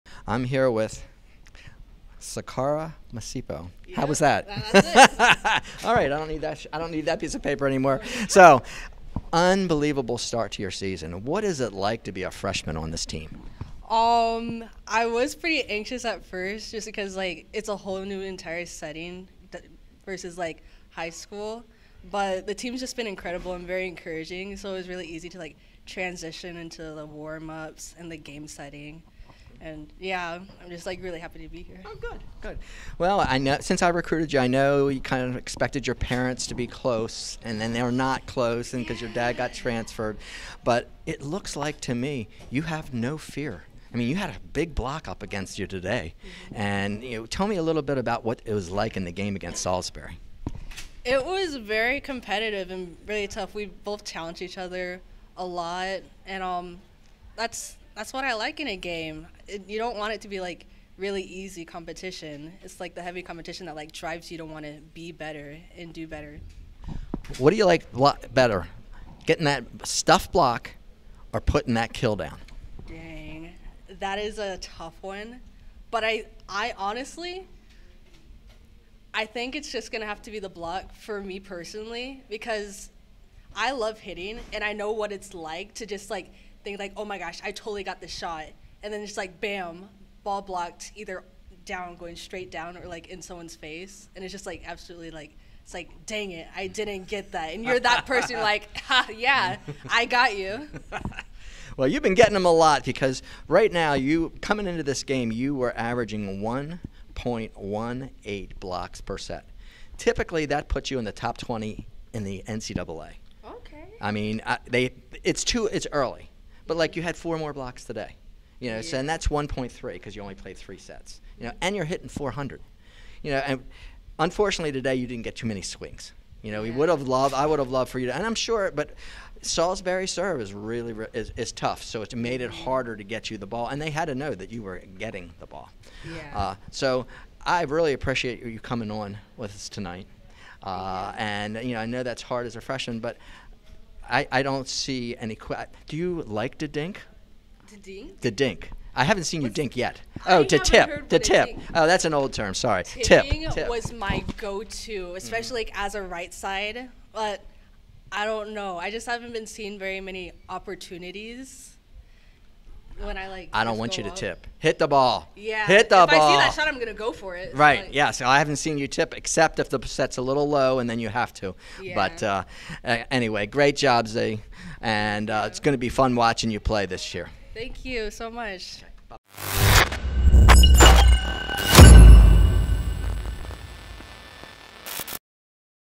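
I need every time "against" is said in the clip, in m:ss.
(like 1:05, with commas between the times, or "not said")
0:45, 0:49.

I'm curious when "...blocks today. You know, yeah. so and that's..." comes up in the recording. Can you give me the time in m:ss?
1:57.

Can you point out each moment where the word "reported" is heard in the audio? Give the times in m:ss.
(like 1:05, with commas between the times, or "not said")
not said.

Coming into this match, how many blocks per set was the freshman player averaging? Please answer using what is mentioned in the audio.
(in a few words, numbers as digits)
1.18.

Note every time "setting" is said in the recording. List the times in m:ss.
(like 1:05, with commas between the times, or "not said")
0:18, 0:28.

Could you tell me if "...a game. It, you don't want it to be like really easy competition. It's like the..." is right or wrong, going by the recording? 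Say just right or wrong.
right.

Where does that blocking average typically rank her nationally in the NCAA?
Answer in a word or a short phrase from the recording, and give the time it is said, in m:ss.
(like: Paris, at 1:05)
top 20, at 1:51.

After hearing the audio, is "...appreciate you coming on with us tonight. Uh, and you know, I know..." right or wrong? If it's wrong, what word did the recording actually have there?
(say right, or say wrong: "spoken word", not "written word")
right.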